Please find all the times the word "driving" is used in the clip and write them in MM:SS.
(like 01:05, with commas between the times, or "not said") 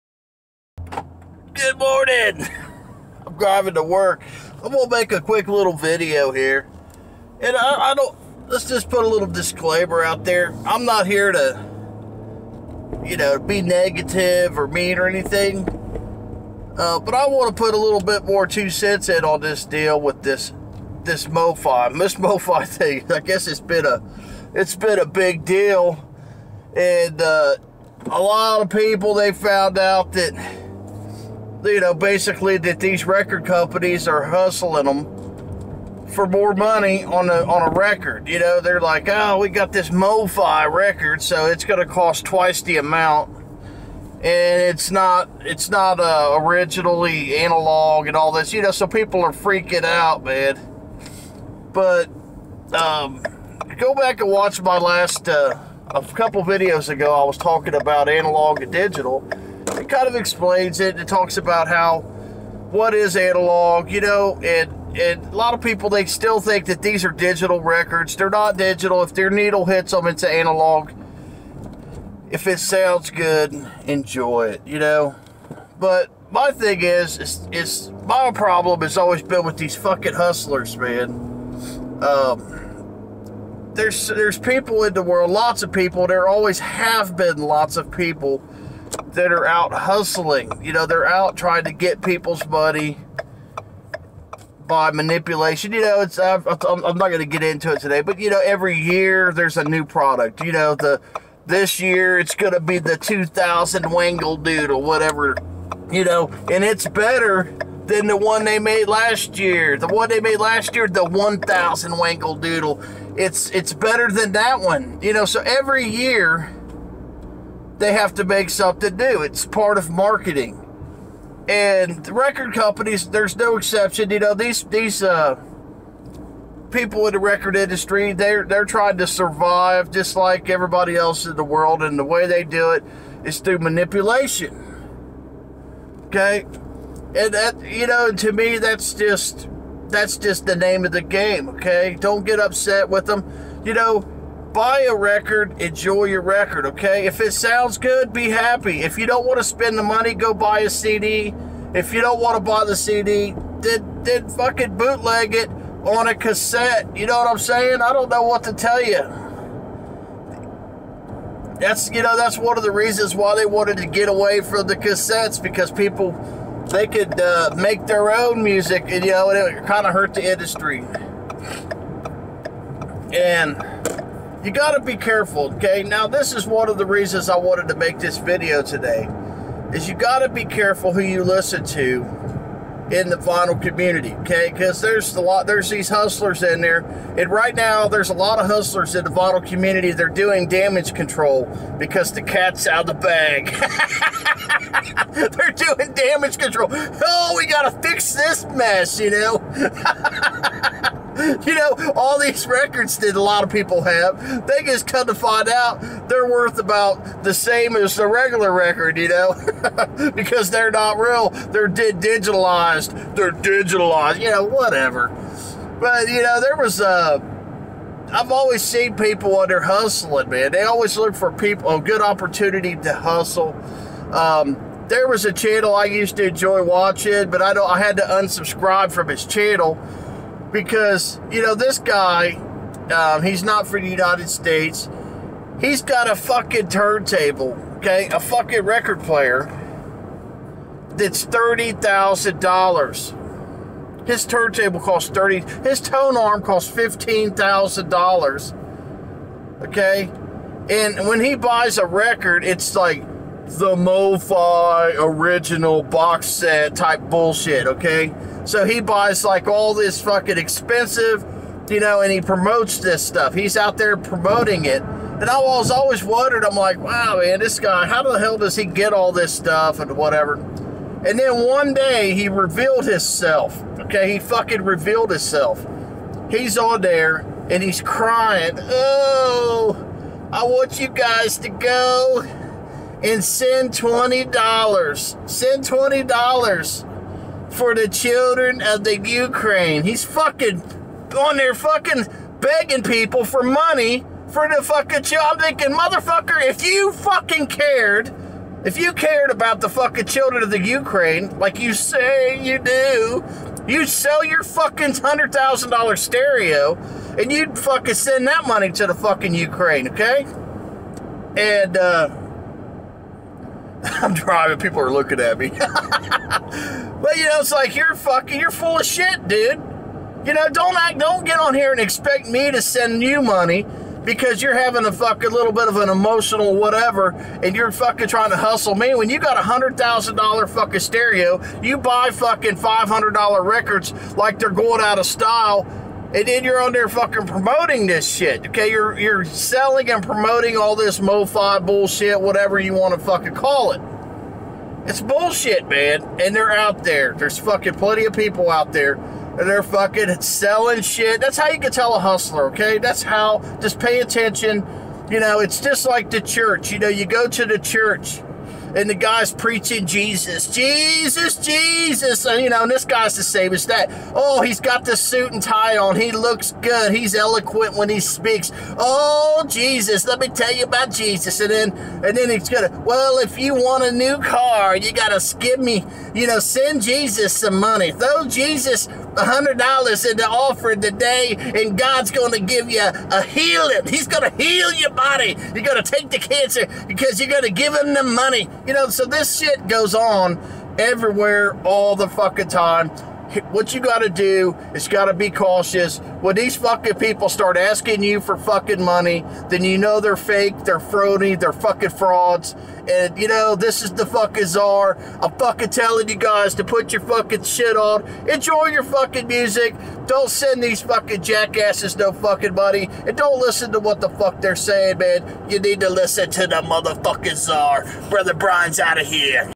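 00:03, 05:14.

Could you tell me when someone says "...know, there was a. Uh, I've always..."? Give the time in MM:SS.
03:36.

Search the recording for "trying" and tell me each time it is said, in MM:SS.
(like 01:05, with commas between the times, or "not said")
01:31, 02:08, 05:28.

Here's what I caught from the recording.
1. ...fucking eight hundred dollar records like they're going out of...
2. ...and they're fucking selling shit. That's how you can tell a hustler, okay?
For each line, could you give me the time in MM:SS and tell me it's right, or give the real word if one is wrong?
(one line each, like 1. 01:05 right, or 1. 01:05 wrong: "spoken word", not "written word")
1. 05:32 wrong: "five", not "eight"
2. 05:48 right.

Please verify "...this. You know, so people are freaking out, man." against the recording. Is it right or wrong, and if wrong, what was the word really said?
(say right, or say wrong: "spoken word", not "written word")
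right.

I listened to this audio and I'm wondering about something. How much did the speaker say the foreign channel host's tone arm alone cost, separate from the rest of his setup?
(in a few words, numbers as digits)
$15,000.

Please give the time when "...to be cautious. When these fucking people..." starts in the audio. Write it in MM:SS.
06:35.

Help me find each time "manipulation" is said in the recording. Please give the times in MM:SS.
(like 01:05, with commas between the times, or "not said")
01:34, 02:13.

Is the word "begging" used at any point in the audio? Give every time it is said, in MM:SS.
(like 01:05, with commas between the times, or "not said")
04:52.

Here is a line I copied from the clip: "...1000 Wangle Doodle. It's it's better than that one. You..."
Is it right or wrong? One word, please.
right.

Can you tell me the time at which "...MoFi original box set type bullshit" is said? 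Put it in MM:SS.
04:13.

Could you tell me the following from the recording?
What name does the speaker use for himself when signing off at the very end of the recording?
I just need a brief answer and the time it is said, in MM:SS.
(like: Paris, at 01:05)
Brother Brian, at 06:58.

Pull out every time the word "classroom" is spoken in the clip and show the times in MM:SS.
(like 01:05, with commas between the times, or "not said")
not said.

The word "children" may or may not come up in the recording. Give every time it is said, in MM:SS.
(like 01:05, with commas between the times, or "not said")
04:47, 04:55, 05:00.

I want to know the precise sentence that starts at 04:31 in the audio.
And then one day he revealed himself.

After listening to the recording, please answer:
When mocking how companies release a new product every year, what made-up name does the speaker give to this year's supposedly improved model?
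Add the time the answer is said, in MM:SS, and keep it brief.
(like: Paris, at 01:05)
2000 Wangle Doodle, at 01:42.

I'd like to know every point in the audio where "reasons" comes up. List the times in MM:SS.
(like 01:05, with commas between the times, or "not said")
02:42, 02:56.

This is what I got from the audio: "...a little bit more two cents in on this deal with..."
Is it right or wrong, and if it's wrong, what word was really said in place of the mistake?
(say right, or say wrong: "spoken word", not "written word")
right.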